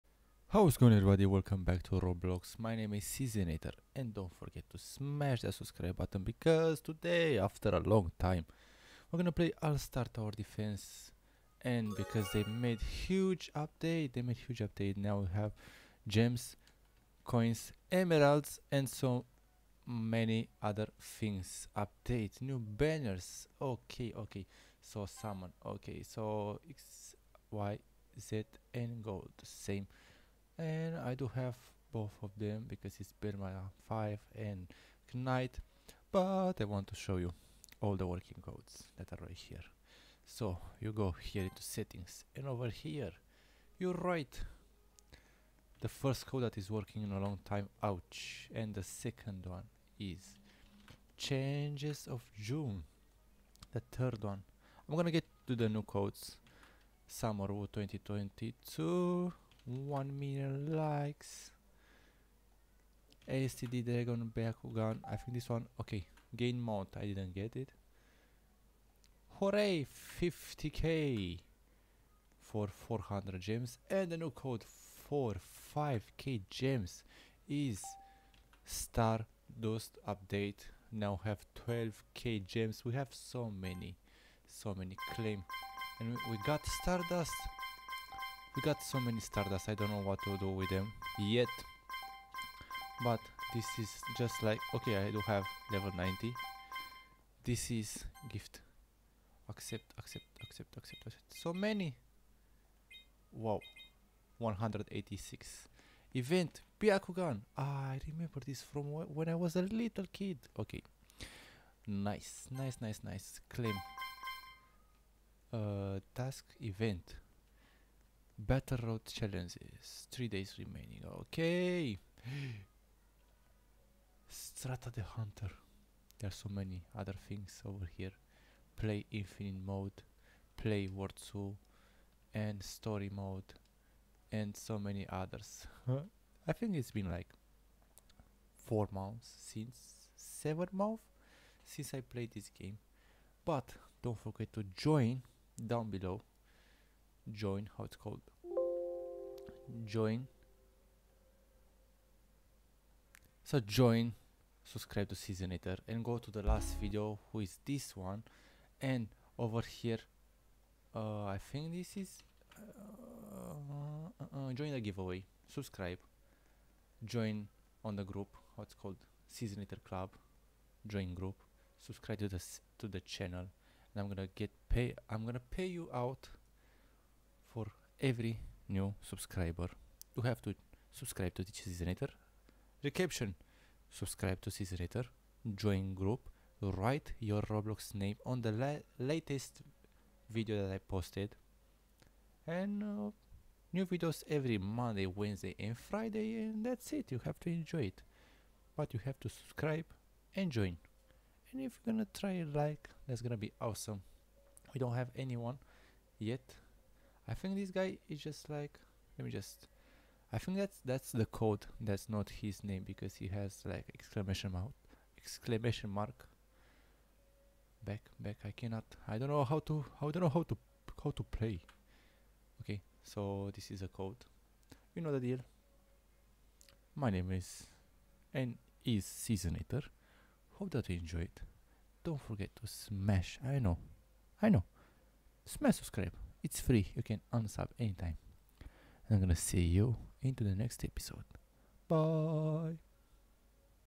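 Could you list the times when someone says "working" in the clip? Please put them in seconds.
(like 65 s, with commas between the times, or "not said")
38 s, 46 s.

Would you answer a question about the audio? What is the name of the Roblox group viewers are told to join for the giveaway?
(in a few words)
Cezinator club.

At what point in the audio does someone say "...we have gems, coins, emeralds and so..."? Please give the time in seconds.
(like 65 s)
15 s.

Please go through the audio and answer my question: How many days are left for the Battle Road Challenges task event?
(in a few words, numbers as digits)
3.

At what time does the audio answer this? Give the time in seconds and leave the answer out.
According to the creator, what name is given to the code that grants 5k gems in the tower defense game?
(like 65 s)
78 s.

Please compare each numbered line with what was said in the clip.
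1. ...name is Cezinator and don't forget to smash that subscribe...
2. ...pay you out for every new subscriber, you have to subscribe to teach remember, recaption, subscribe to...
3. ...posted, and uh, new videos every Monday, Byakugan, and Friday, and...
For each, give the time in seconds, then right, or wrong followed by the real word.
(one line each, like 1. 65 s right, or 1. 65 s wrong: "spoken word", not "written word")
1. 2 s right
2. 175 s wrong: "newsletter", not "remember"
3. 190 s wrong: "Wednesday", not "Byakugan".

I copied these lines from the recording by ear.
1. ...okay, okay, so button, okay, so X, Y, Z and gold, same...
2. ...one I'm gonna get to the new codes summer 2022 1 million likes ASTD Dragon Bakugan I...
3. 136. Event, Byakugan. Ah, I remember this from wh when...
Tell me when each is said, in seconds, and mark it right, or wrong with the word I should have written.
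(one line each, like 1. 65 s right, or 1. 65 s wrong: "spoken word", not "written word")
1. 23 s wrong: "summon", not "button"
2. 54 s right
3. 104 s wrong: "186", not "136".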